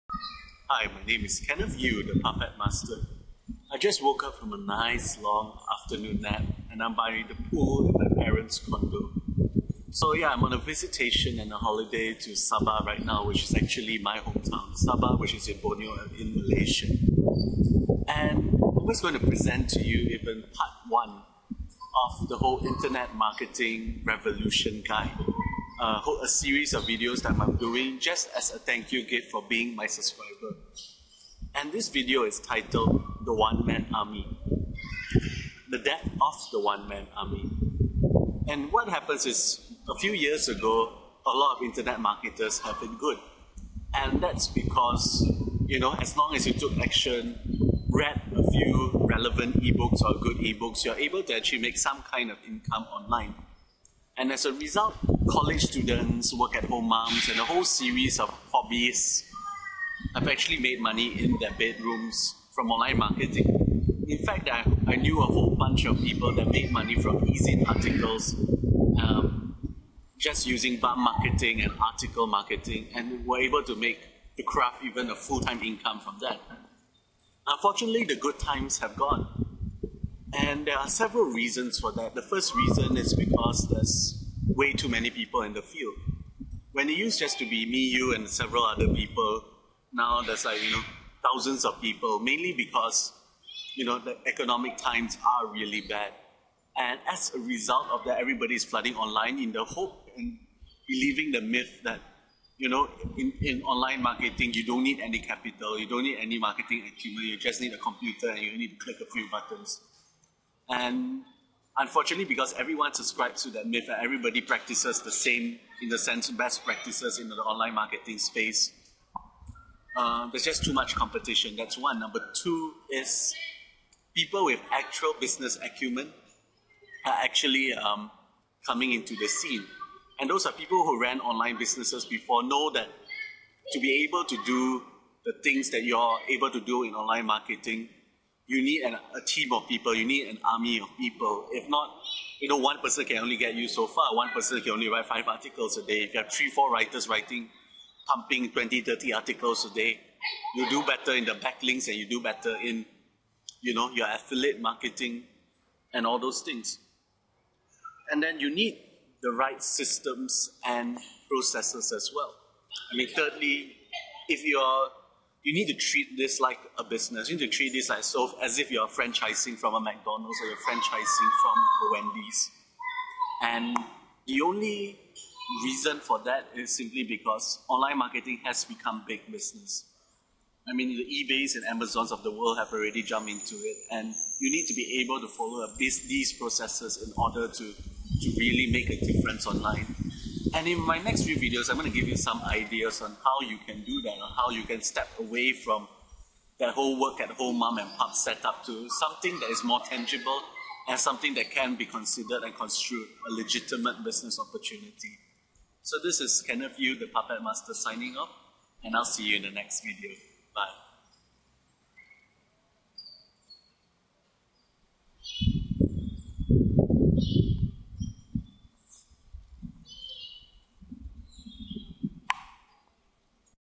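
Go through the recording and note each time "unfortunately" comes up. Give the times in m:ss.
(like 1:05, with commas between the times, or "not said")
1:17, 1:51.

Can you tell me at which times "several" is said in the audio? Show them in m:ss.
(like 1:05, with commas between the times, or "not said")
1:20, 1:28.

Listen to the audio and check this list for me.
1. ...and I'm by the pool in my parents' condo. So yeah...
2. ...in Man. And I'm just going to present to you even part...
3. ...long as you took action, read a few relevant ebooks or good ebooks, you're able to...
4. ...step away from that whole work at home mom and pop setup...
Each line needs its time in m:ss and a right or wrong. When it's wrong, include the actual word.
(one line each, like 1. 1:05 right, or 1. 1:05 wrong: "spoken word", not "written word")
1. 0:06 right
2. 0:16 wrong: "Malaysia", not "Man"
3. 0:46 right
4. 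3:14 right.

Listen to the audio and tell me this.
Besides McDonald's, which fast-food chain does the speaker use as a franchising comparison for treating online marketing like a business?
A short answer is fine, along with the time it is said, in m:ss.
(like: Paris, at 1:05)
Wendy's, at 2:52.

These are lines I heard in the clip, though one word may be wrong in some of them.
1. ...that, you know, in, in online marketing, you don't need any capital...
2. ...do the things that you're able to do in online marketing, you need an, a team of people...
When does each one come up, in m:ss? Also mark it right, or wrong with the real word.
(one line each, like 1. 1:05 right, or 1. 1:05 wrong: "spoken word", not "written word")
1. 1:41 right
2. 2:14 right.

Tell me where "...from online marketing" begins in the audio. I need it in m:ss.
1:02.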